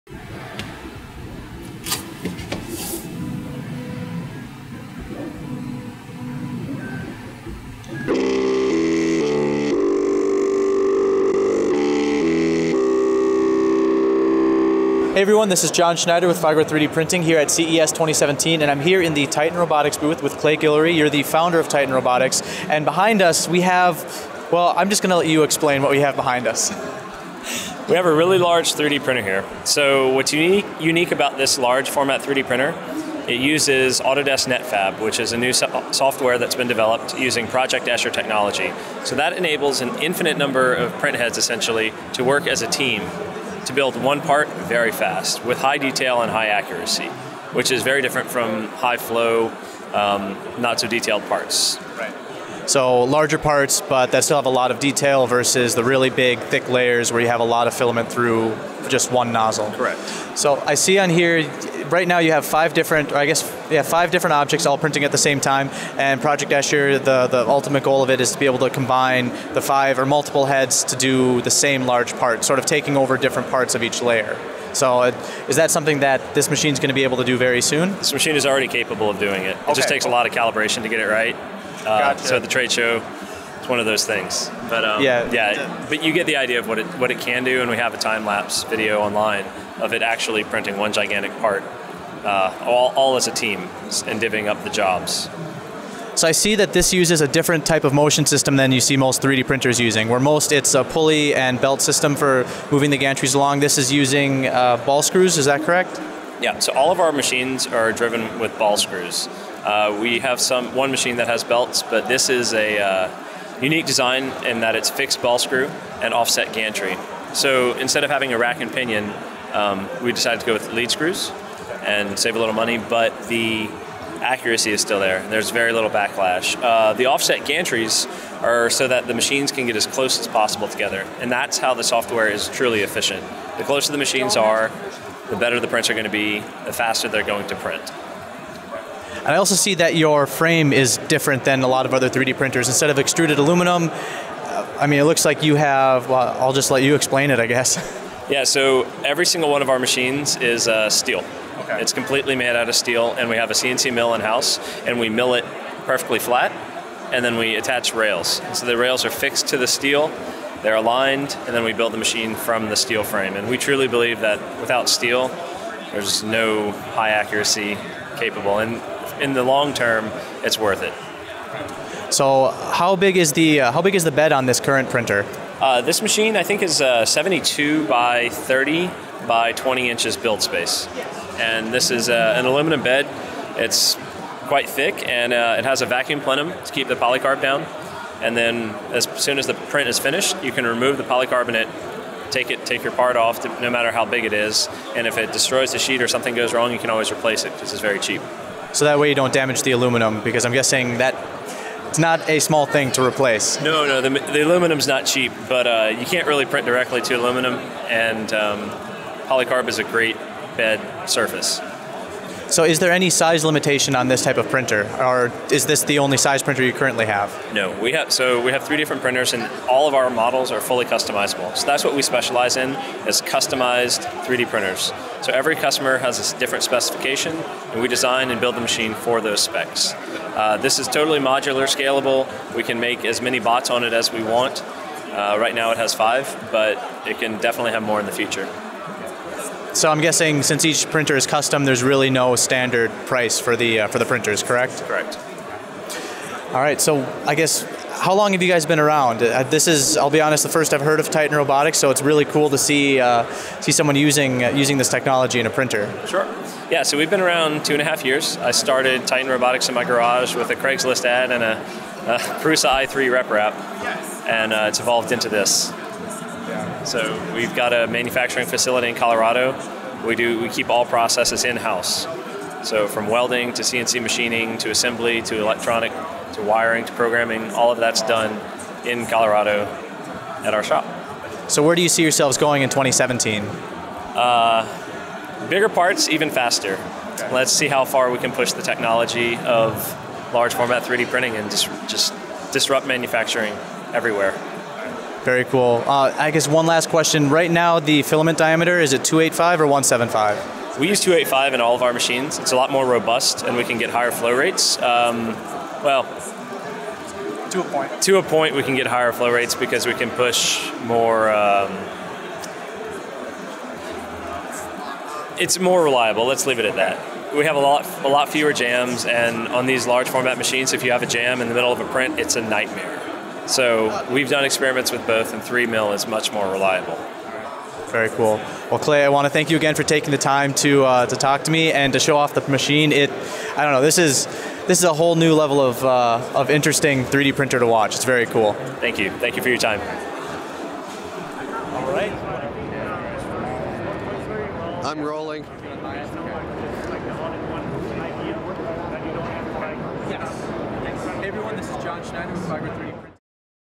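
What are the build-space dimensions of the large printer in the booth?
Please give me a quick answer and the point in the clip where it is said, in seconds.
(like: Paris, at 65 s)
72 by 30 by 20 inches, at 177 s.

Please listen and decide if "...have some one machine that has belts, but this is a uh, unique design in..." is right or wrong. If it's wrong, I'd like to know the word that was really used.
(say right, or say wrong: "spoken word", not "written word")
right.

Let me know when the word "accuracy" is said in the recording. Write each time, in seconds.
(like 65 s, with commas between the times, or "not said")
46 s, 124 s, 167 s.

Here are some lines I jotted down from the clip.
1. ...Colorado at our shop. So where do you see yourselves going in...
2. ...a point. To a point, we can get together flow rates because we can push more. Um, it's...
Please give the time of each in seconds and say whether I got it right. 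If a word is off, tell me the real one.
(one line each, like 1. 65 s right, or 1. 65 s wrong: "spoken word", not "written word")
1. 279 s right
2. 307 s wrong: "higher", not "together".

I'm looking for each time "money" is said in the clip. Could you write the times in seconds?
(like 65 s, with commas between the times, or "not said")
122 s.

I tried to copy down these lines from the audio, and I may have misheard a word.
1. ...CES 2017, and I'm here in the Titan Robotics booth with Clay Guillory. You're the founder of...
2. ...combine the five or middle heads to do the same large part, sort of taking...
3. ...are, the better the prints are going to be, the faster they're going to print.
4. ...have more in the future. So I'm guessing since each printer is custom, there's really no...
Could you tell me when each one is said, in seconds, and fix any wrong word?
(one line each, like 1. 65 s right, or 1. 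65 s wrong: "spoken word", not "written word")
1. 17 s right
2. 68 s wrong: "multiple", not "middle"
3. 134 s right
4. 237 s right.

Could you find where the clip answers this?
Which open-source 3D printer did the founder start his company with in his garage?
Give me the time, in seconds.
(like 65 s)
262 s.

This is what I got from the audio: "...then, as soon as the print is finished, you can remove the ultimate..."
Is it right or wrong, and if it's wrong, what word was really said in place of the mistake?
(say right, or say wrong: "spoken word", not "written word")
wrong: "polycarbonate", not "ultimate".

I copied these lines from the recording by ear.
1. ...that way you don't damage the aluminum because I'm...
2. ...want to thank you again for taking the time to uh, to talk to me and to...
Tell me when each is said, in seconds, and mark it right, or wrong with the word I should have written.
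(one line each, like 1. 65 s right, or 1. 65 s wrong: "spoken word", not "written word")
1. 198 s right
2. 329 s right.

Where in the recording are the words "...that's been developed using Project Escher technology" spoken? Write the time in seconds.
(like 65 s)
36 s.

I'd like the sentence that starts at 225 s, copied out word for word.
So every customer has a different specification, and we design and build the machine for those specs.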